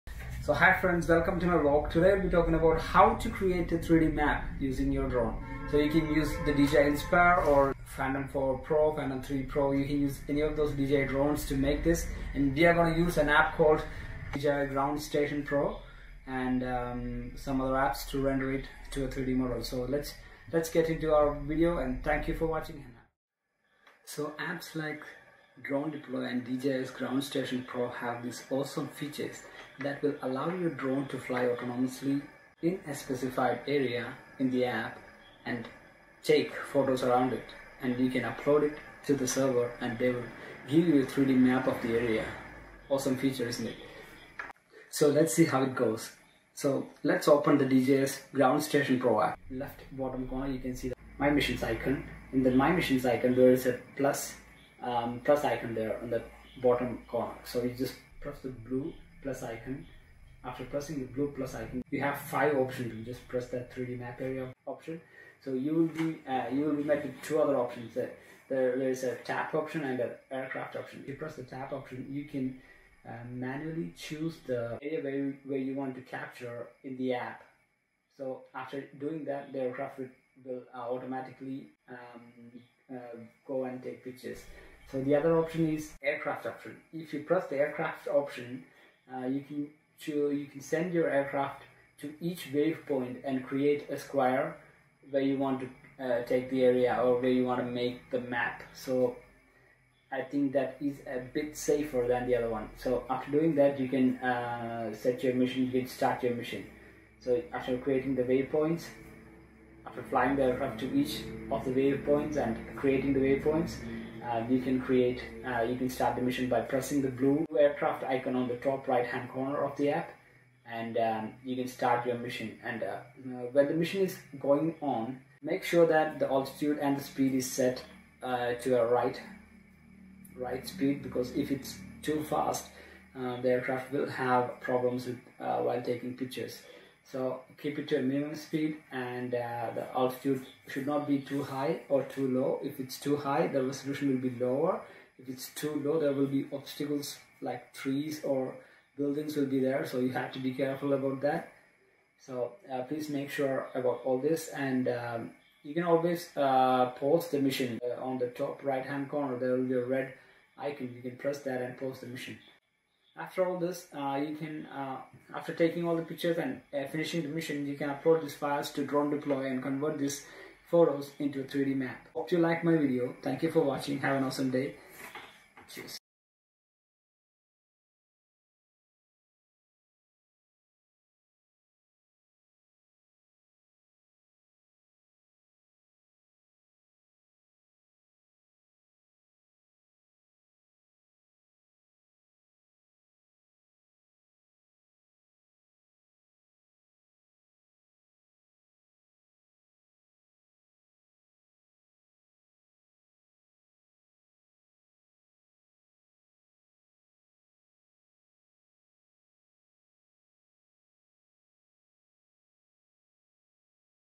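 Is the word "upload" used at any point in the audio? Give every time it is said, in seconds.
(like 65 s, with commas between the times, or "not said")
38 s, 167 s.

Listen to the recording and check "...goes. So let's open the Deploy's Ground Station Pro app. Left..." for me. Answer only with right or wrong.
wrong.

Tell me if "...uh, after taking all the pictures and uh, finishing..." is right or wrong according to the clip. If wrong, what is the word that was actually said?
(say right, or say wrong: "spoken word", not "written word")
right.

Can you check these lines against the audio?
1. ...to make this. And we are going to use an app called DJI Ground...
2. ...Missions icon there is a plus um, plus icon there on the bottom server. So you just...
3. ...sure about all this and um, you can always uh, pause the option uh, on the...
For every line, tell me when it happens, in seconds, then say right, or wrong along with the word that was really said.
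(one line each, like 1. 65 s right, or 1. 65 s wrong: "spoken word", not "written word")
1. 11 s right
2. 52 s wrong: "corner", not "server"
3. 153 s wrong: "mission", not "option".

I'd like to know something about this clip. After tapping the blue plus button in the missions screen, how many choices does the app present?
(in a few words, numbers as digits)
5.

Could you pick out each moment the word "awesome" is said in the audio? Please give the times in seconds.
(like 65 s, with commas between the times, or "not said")
28 s, 42 s, 174 s.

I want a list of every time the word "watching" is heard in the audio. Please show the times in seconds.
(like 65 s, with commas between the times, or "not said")
22 s, 173 s.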